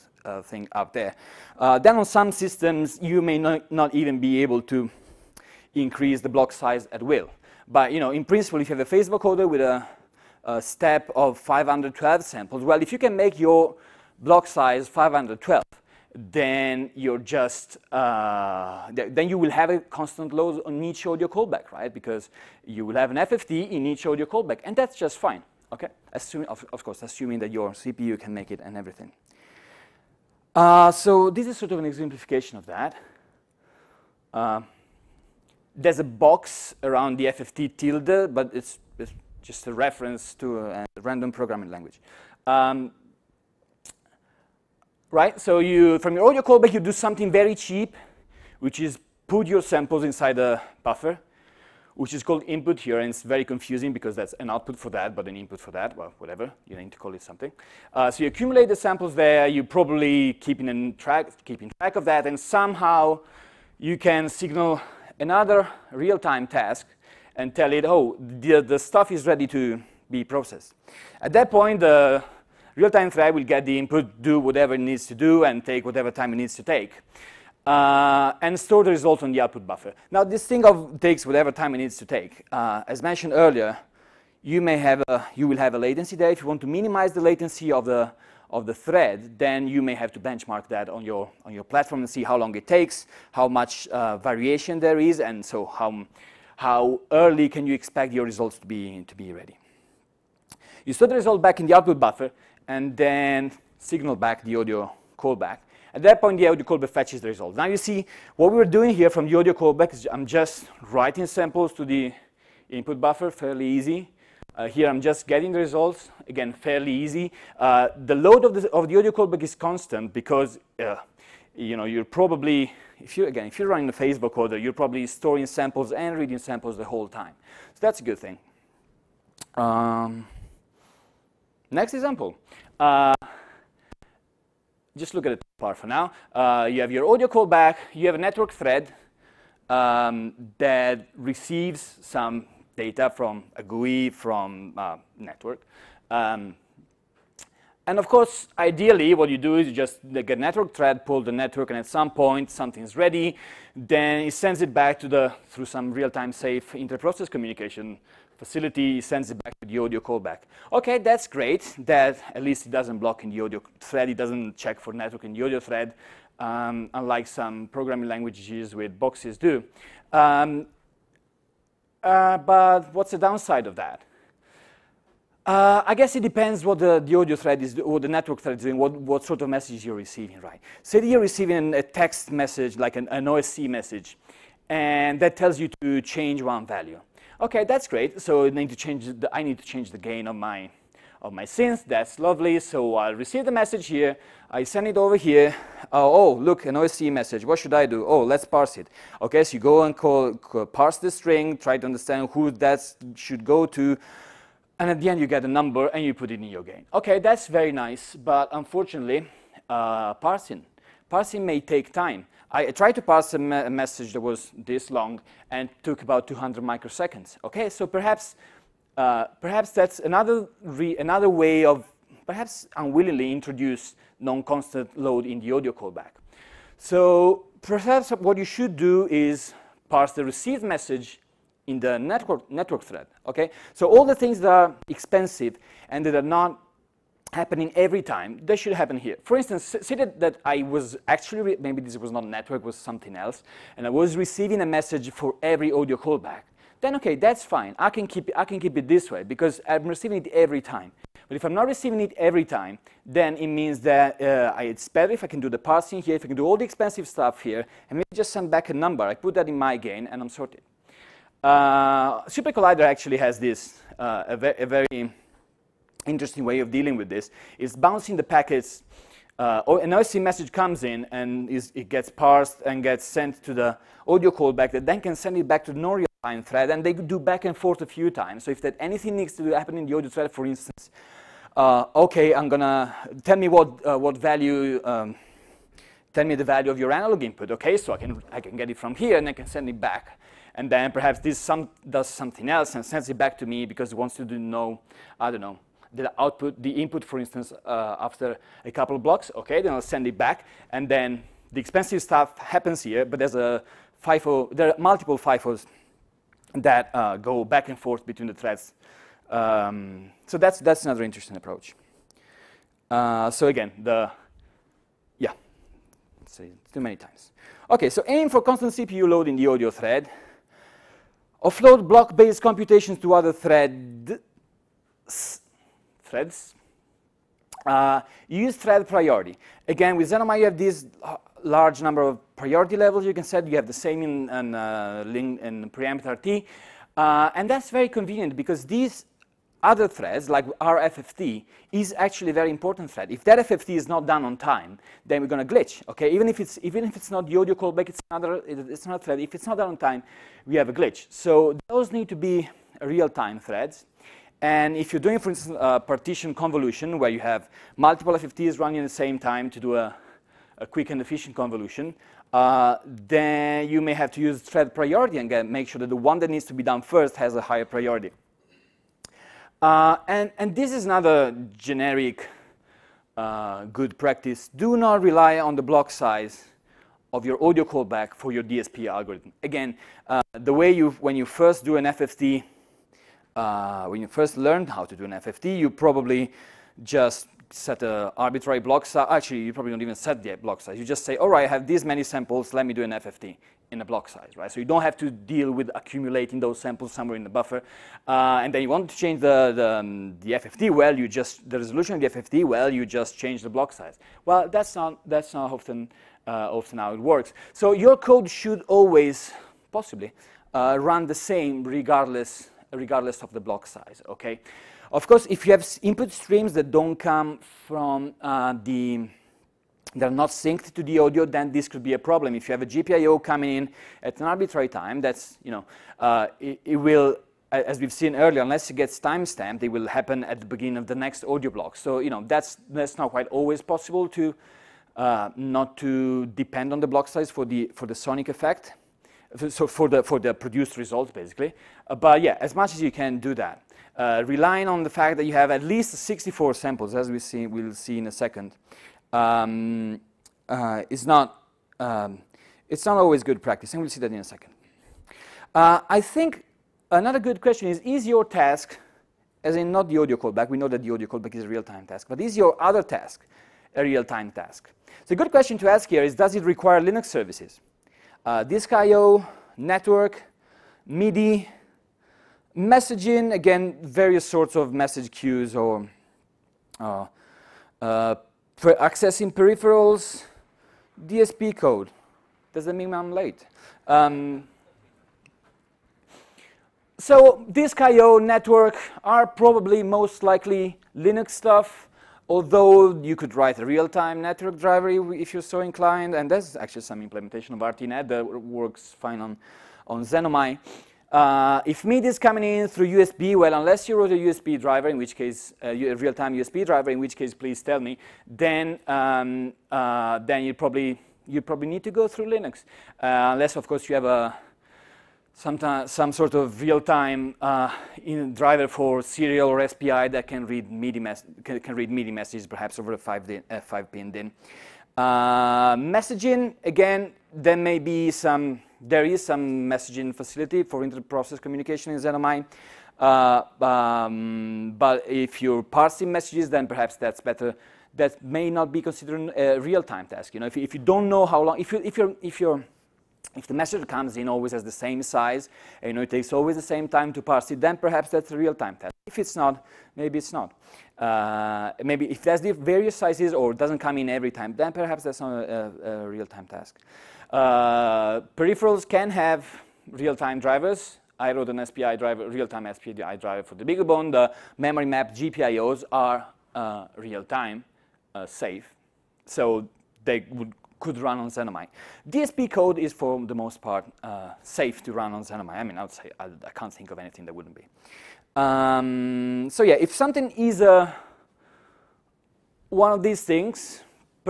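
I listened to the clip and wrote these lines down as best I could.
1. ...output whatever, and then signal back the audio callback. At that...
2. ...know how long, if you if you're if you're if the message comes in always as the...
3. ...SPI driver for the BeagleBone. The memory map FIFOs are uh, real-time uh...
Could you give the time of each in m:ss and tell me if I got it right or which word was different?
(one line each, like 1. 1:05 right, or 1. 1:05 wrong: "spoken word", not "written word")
1. 1:41 wrong: "buffer", not "whatever"
2. 9:01 right
3. 9:22 wrong: "GPIOs", not "FIFOs".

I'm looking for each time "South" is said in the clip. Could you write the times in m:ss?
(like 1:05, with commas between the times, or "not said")
not said.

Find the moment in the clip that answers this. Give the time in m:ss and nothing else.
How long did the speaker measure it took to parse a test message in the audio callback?
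3:36.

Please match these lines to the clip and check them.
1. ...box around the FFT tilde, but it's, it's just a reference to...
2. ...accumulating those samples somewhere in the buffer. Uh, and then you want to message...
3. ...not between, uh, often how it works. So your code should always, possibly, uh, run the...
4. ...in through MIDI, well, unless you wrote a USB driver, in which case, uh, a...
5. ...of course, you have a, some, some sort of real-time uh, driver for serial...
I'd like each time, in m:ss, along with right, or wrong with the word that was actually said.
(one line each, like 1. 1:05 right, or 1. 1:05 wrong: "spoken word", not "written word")
1. 0:36 right
2. 6:35 wrong: "change", not "message"
3. 6:45 wrong: "often", not "between"
4. 8:22 wrong: "USB", not "MIDI"
5. 8:33 right.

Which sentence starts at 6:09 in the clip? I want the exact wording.
Uh, and, and this is another generic uh, good practice.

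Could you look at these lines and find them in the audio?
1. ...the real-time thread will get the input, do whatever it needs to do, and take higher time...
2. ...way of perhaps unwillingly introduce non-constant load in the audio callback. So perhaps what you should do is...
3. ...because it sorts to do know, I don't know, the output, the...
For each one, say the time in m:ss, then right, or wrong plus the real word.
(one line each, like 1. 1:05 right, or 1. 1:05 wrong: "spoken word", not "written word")
1. 1:11 wrong: "whatever", not "higher"
2. 3:41 right
3. 4:53 wrong: "wants", not "sorts".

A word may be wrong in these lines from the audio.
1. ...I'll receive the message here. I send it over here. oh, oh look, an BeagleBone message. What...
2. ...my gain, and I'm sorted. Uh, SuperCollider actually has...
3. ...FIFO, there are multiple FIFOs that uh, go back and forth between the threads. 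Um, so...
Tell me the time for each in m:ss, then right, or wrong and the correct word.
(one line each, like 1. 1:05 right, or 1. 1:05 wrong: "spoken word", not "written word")
1. 3:12 wrong: "OSC", not "BeagleBone"
2. 4:19 right
3. 5:04 right.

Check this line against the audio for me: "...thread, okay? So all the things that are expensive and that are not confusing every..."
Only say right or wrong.
wrong.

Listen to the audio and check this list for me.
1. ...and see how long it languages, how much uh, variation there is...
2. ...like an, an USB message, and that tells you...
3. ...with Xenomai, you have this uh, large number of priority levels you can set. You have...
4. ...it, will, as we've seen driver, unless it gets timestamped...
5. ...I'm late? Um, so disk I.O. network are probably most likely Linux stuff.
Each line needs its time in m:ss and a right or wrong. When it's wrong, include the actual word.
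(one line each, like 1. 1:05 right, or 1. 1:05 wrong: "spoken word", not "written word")
1. 1:32 wrong: "takes", not "languages"
2. 3:02 wrong: "OSC", not "USB"
3. 5:29 right
4. 7:06 wrong: "earlier", not "driver"
5. 8:02 right.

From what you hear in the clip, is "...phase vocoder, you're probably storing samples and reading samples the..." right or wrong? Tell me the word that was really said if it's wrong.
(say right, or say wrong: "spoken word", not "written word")
right.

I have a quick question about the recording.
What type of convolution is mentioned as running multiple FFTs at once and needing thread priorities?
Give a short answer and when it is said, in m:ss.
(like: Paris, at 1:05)
partition convolution, at 5:55.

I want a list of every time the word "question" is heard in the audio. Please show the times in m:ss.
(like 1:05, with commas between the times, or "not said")
7:37, 7:45.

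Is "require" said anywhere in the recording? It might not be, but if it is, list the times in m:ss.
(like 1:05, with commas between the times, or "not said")
7:46.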